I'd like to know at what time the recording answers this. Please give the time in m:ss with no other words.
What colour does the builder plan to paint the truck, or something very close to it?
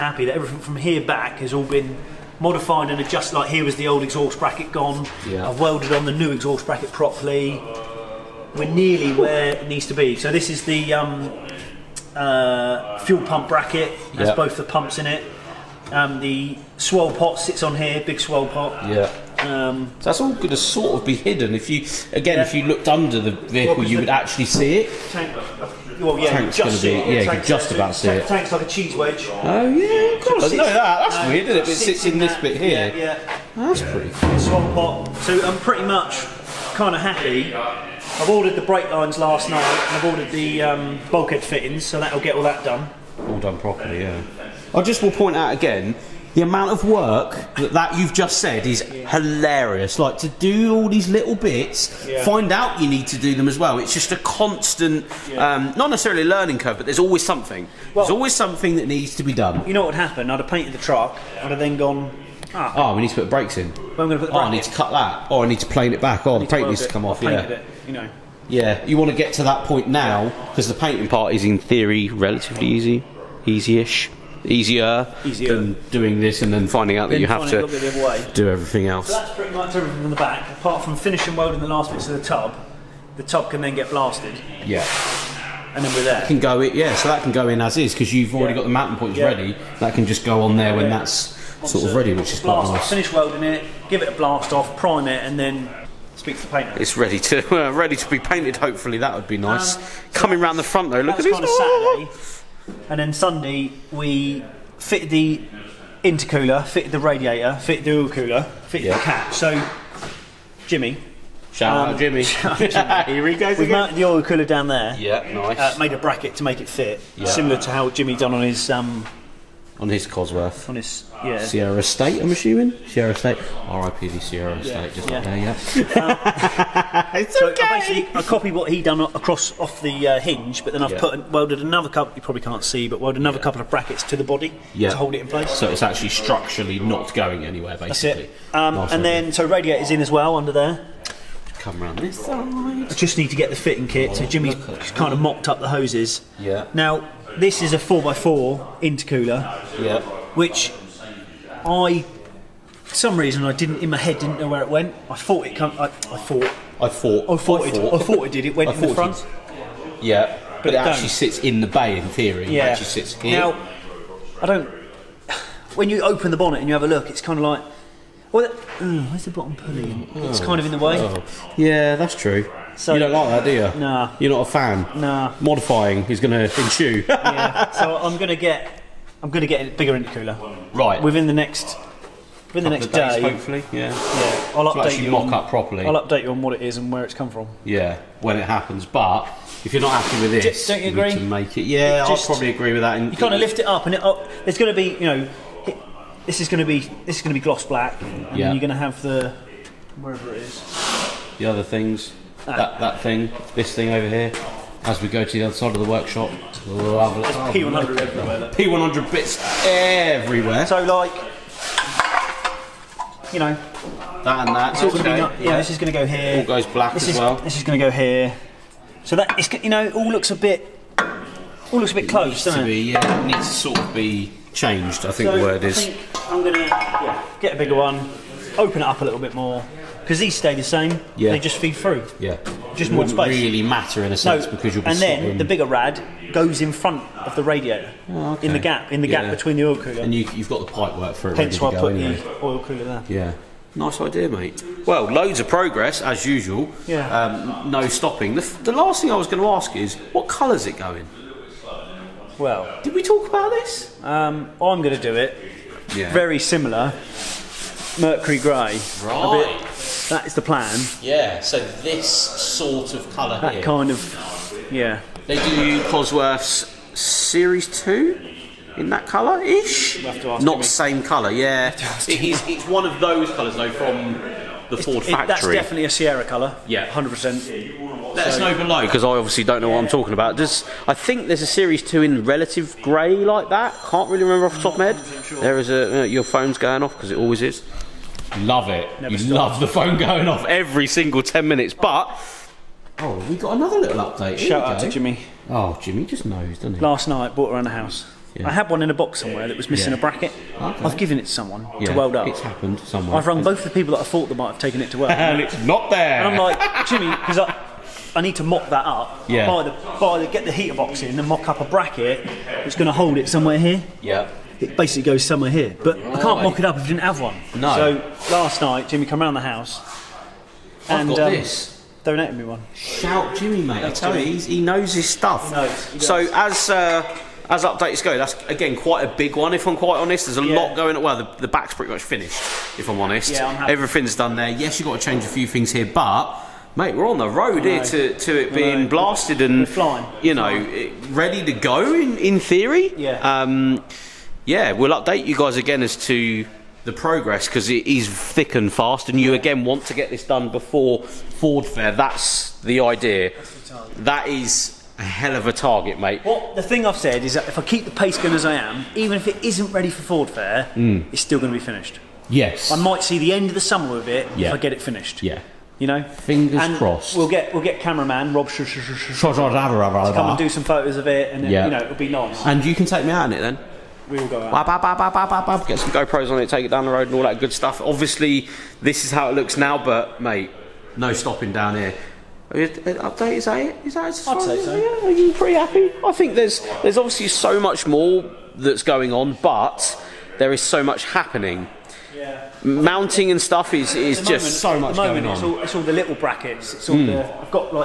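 4:18.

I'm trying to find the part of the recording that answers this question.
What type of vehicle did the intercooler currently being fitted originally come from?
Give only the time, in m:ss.
2:27.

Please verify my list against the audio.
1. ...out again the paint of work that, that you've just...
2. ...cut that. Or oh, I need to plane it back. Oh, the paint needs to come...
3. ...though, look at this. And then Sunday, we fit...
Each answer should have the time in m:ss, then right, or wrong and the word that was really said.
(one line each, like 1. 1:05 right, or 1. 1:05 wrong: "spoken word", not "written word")
1. 0:45 wrong: "amount", not "paint"
2. 1:04 right
3. 1:40 right.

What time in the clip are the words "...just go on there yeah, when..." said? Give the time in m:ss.
1:30.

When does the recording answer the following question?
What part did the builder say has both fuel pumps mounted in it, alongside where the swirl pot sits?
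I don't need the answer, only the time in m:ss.
0:12.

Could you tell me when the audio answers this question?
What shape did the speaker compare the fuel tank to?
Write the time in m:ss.
0:28.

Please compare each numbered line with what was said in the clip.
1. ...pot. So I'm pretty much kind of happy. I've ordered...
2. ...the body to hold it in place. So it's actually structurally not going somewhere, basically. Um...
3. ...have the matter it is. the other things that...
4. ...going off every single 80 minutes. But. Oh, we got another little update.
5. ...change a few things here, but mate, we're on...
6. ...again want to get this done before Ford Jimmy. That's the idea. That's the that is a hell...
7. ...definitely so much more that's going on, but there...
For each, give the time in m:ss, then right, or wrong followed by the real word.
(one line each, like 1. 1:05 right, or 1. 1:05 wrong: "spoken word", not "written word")
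1. 0:34 right
2. 2:14 wrong: "anywhere", not "somewhere"
3. 3:18 wrong: "wherever", not "matter"
4. 4:49 wrong: "10", not "80"
5. 5:35 right
6. 5:49 wrong: "Fair", not "Jimmy"
7. 6:26 wrong: "obviously", not "definitely".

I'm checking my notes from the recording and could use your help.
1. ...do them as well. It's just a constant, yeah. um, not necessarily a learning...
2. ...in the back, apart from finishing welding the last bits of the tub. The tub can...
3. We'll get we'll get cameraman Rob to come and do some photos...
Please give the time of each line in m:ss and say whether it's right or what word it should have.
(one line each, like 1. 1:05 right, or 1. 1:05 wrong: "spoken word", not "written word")
1. 0:53 right
2. 1:20 right
3. 6:07 right.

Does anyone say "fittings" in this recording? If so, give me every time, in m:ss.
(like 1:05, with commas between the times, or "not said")
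0:41, 2:23.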